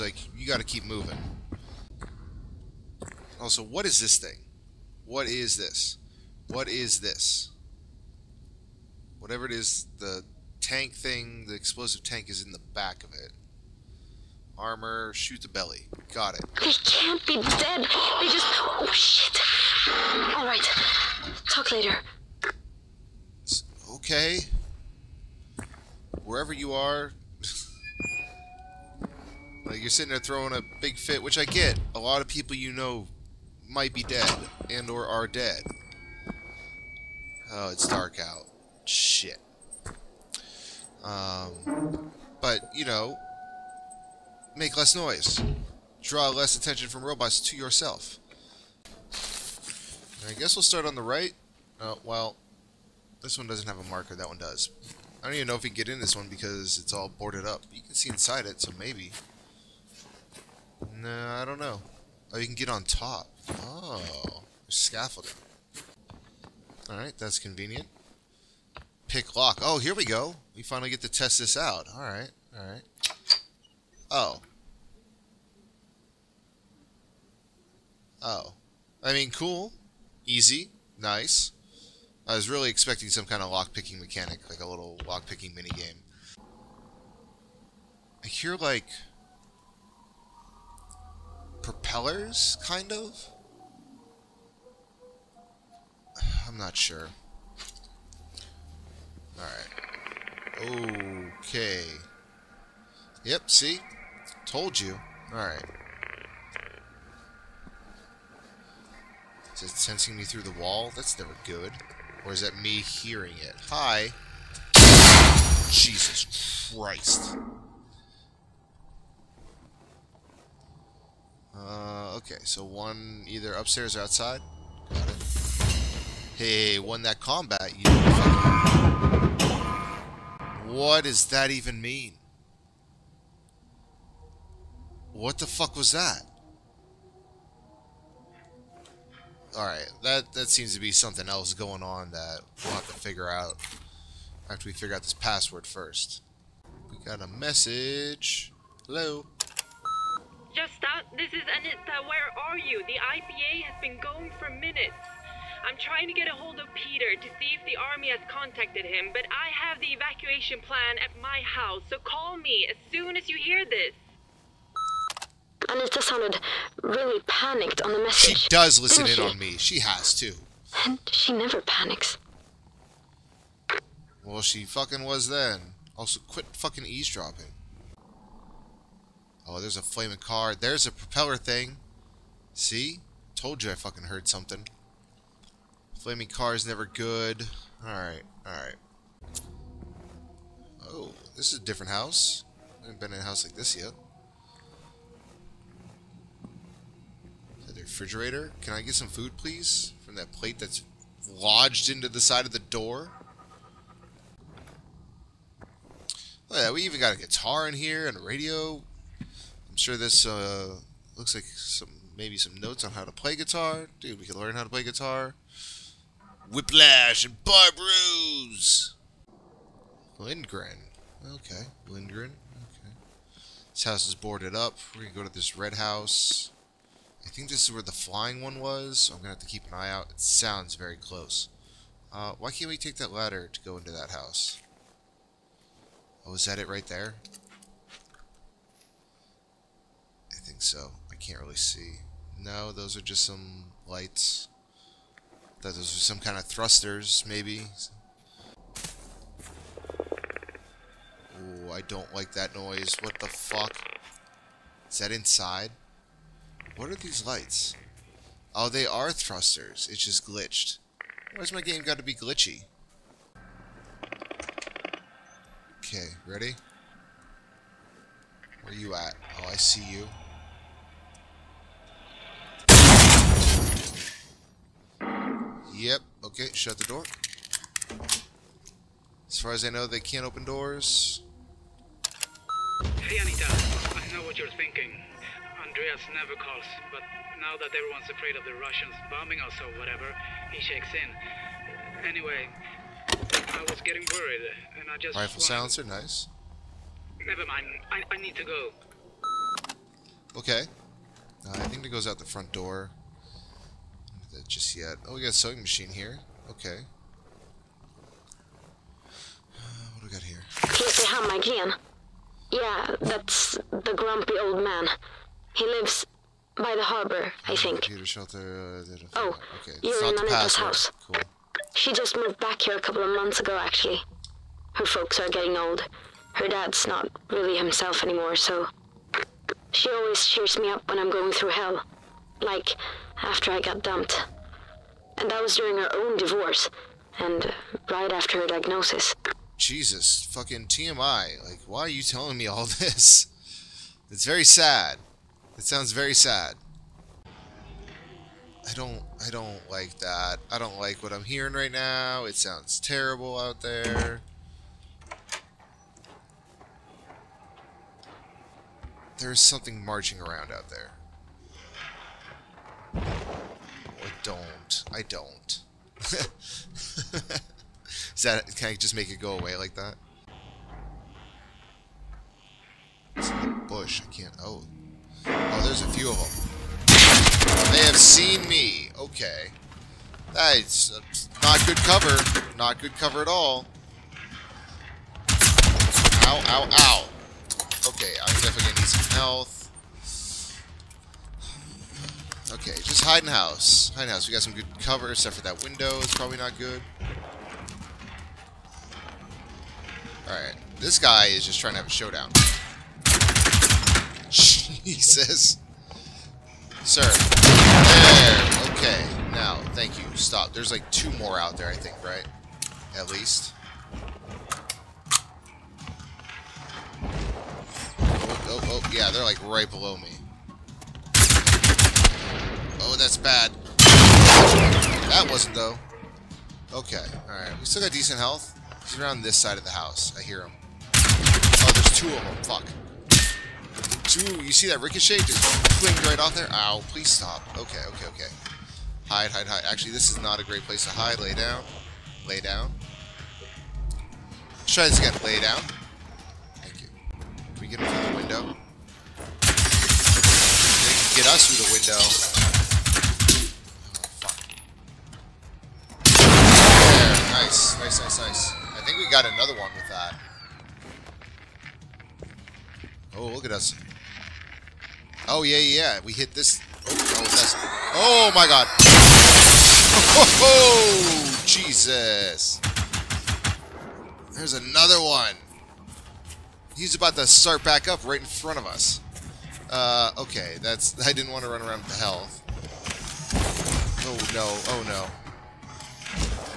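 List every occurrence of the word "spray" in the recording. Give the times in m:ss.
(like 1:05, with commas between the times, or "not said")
not said.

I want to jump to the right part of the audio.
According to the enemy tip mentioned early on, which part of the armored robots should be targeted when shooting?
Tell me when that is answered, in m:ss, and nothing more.
0:15.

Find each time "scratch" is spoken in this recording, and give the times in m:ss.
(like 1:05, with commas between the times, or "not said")
not said.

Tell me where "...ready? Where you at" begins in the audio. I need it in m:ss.
4:26.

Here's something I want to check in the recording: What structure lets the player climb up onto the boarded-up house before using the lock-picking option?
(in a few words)
Scaffolding.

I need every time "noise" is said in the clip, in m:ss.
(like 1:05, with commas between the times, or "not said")
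0:44, 4:12.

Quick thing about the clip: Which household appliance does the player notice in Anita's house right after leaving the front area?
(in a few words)
Sewing machine.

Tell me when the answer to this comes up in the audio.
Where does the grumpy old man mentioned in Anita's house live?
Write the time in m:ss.
5:16.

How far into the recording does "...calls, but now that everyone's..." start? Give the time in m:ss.
4:46.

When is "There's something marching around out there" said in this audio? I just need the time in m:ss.
5:59.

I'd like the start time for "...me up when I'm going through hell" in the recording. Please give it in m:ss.
5:30.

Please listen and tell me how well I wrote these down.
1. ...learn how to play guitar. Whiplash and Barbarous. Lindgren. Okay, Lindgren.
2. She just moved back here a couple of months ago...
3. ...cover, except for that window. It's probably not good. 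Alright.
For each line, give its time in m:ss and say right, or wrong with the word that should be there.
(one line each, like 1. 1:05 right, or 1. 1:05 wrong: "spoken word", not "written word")
1. 3:34 right
2. 5:21 right
3. 6:34 right.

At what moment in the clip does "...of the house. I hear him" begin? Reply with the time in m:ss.
7:09.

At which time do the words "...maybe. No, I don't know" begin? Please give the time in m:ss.
0:58.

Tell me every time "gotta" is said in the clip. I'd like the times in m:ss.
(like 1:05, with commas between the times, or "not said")
0:00.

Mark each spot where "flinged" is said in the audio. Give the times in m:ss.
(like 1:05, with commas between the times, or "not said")
7:15.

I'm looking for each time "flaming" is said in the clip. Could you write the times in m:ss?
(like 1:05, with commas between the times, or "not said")
2:59, 3:06.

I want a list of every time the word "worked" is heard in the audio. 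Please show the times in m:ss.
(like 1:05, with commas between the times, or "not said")
not said.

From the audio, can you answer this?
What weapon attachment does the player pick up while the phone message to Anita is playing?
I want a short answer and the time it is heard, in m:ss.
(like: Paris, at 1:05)
Rifle silencer, at 4:55.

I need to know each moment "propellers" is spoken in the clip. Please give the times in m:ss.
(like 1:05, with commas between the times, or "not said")
1:31, 3:00.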